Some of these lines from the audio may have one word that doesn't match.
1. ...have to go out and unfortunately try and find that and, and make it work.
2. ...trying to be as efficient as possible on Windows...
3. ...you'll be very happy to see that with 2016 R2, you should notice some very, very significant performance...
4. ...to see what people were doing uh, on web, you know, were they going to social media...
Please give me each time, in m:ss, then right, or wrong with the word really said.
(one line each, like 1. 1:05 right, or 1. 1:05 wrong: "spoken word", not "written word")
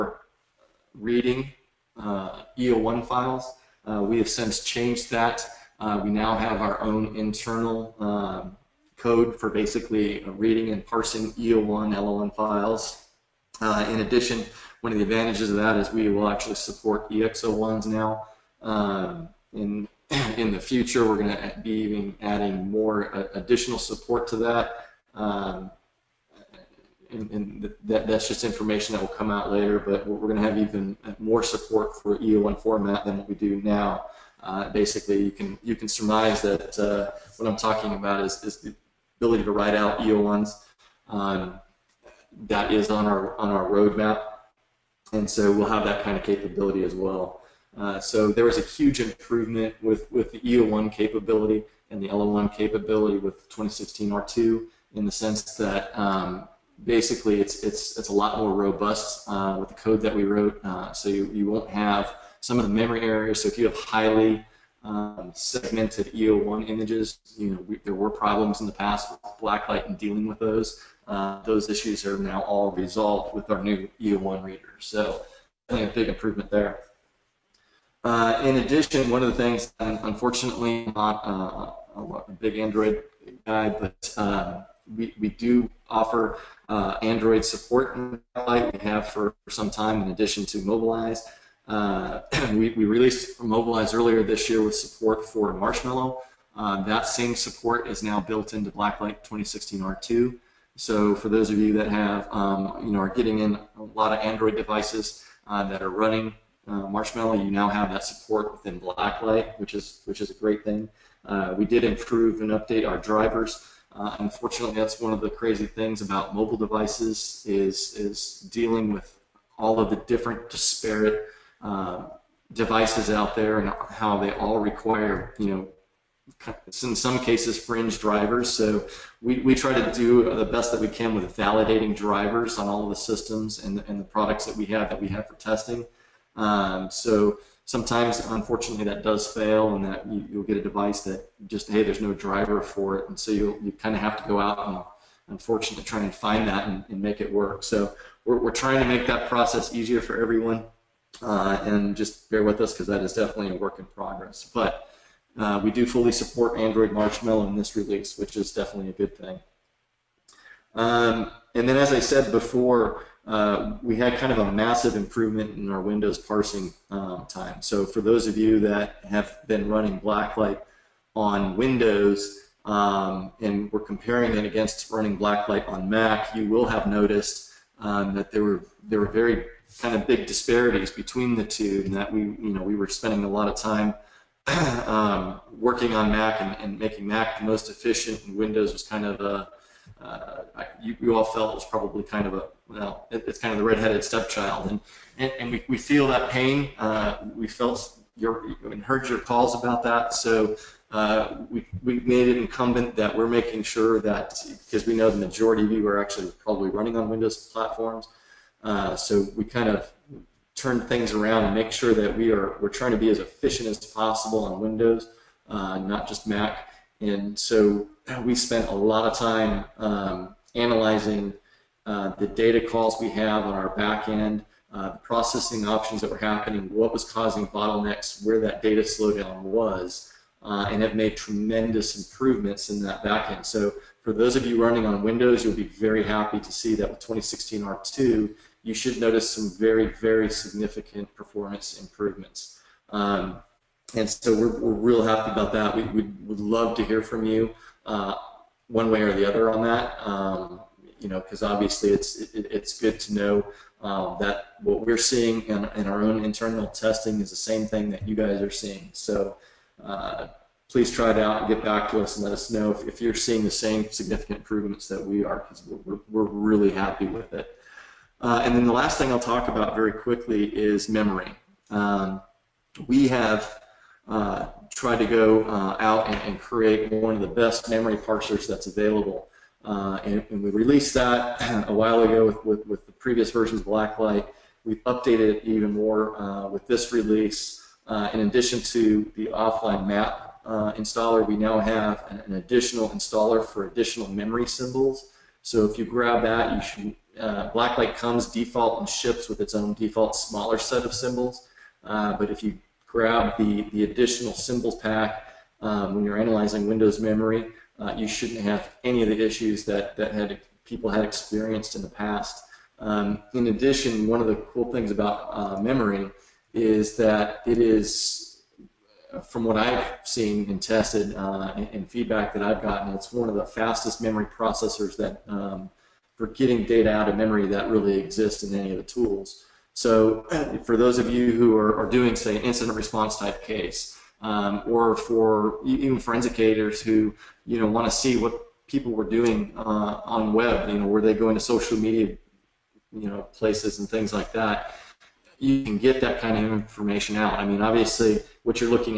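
1. 2:24 right
2. 3:32 right
3. 3:55 right
4. 5:37 right.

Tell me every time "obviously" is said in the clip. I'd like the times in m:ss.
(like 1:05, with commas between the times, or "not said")
4:11, 5:47.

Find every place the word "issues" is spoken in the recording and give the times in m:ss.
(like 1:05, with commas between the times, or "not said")
1:11, 5:09.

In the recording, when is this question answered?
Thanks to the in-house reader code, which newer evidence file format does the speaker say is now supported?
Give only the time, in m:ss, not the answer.
0:17.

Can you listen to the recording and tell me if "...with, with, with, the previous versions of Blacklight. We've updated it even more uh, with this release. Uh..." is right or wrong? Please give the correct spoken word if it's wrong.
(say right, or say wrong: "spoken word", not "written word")
right.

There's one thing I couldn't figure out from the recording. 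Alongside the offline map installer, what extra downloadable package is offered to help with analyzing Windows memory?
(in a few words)
additional memory symbols.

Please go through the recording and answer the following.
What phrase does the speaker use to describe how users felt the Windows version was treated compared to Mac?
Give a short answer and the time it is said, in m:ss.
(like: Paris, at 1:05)
redheaded stepchild, at 3:13.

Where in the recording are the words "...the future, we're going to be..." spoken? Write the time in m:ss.
0:20.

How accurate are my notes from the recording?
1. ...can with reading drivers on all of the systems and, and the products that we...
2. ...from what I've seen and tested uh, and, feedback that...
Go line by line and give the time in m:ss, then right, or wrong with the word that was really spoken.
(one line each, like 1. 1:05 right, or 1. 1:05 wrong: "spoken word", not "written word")
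1. 2:10 wrong: "validating", not "reading"
2. 5:19 right.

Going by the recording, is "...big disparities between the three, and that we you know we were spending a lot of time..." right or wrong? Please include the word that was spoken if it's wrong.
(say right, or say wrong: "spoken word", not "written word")
wrong: "two", not "three".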